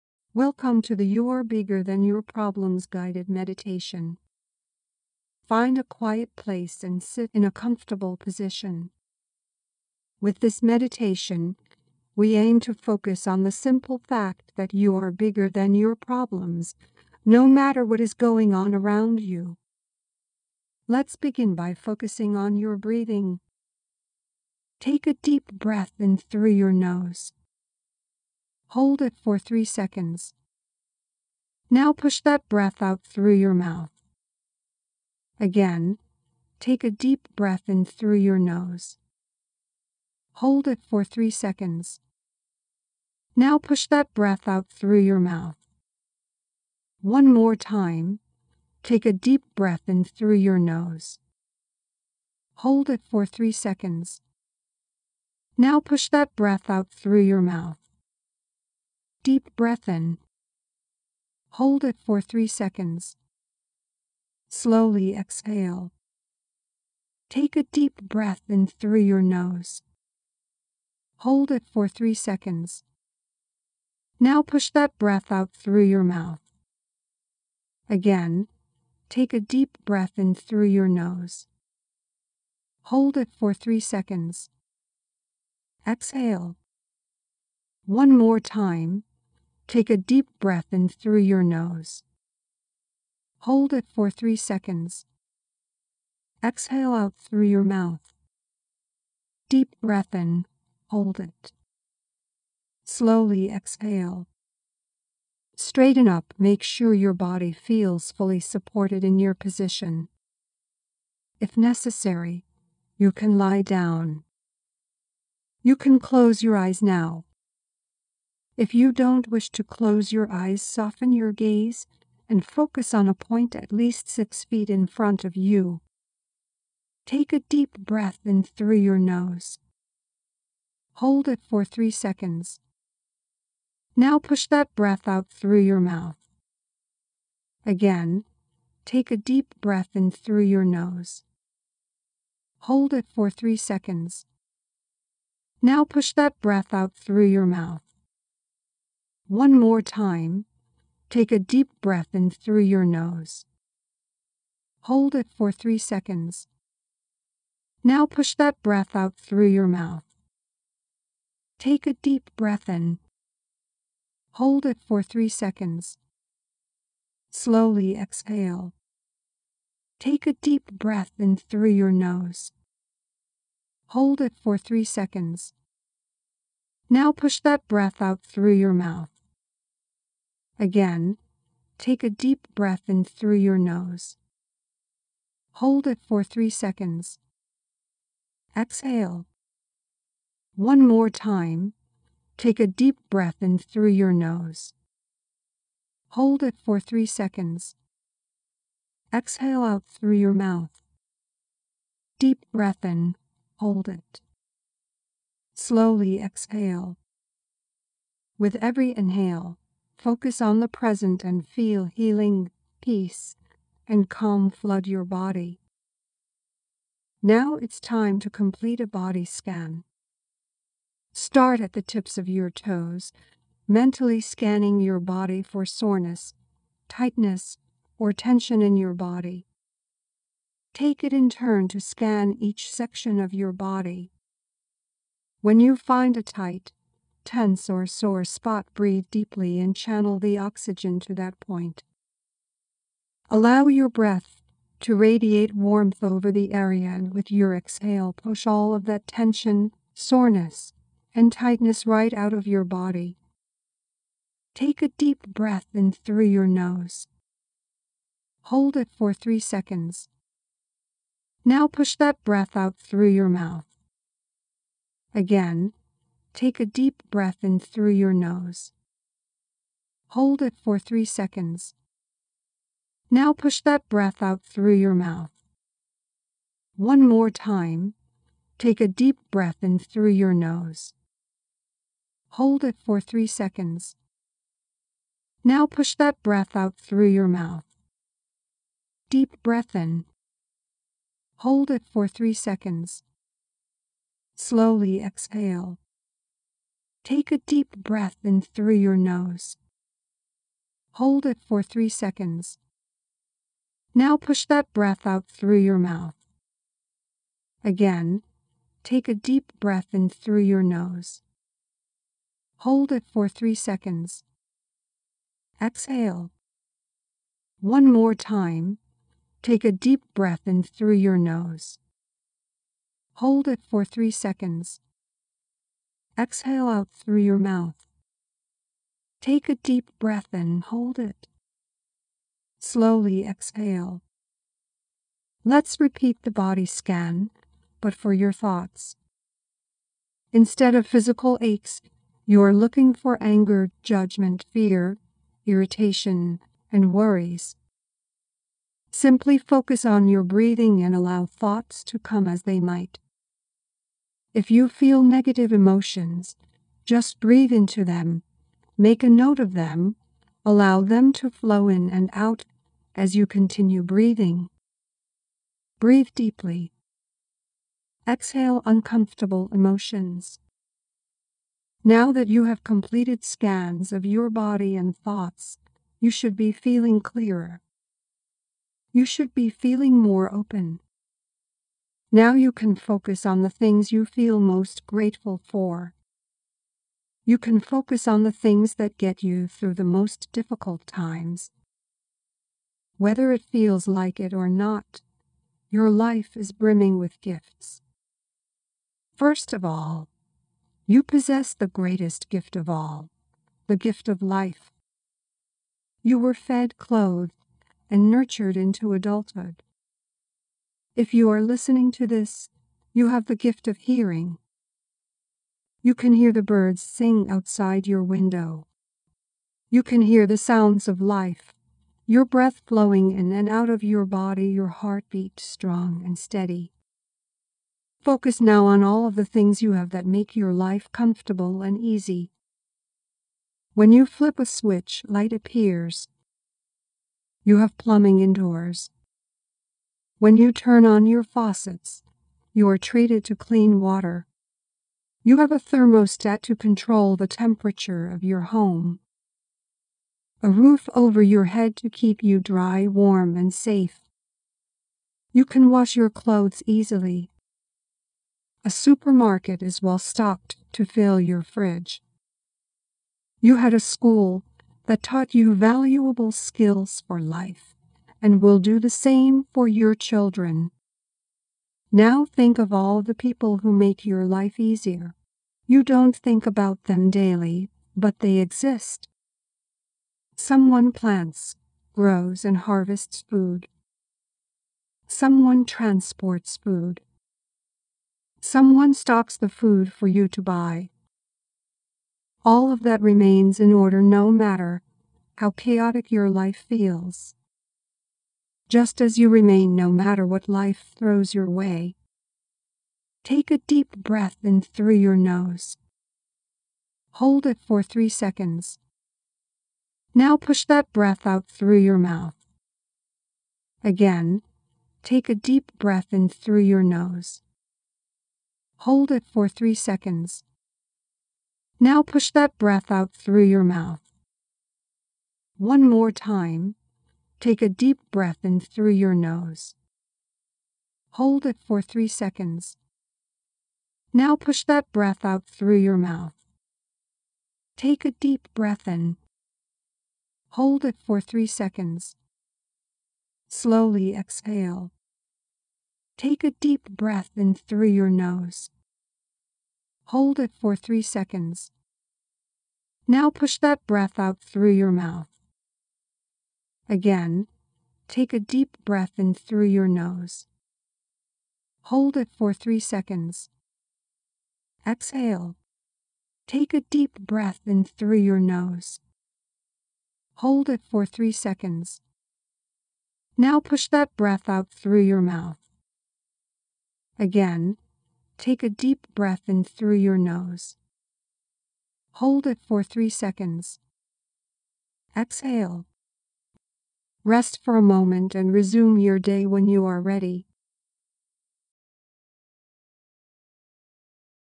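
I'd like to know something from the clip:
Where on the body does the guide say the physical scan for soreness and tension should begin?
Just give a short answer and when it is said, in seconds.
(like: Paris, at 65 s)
Tips of your toes, at 221 s.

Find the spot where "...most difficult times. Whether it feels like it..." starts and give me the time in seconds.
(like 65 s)
389 s.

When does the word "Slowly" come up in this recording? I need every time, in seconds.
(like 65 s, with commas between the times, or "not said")
64 s, 102 s, 167 s, 205 s, 294 s, 332 s, 543 s.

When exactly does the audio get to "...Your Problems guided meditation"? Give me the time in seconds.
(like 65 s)
2 s.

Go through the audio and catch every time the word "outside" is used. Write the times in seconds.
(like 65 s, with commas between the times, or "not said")
417 s.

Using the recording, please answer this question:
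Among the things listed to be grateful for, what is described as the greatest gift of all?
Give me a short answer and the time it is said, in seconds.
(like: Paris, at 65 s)
The gift of life, at 403 s.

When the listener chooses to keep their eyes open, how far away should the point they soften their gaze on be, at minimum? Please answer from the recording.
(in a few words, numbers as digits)
6 feet.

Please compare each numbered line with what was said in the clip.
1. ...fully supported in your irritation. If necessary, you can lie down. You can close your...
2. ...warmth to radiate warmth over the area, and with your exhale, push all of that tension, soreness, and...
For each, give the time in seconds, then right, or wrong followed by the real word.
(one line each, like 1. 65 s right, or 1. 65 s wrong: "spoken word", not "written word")
1. 108 s wrong: "position", not "irritation"
2. 243 s wrong: "breath", not "warmth".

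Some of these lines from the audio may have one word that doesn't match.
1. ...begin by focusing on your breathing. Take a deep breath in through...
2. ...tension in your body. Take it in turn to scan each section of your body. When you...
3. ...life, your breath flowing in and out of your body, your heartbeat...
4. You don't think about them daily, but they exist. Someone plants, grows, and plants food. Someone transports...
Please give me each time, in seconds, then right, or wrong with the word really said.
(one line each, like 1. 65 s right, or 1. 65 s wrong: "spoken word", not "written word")
1. 21 s right
2. 228 s right
3. 420 s right
4. 475 s wrong: "harvests", not "plants".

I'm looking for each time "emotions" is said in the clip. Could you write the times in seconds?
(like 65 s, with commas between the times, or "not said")
355 s, 369 s.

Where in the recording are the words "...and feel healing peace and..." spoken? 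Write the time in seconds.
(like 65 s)
211 s.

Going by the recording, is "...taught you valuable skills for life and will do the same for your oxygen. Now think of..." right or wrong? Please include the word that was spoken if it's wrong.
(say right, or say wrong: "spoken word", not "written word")
wrong: "children", not "oxygen".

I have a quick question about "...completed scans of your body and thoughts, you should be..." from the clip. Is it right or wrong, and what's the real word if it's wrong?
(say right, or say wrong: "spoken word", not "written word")
right.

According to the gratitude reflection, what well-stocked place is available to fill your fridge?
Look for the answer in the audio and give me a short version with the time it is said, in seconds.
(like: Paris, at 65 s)
A supermarket, at 458 s.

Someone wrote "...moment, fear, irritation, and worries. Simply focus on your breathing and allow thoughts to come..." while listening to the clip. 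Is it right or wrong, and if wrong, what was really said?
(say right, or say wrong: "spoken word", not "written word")
wrong: "judgment", not "moment".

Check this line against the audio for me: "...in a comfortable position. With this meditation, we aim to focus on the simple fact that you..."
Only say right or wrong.
right.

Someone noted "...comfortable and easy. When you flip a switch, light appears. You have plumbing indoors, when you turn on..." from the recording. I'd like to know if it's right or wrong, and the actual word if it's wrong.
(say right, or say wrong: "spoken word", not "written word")
right.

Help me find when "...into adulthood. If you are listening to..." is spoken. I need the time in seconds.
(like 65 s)
408 s.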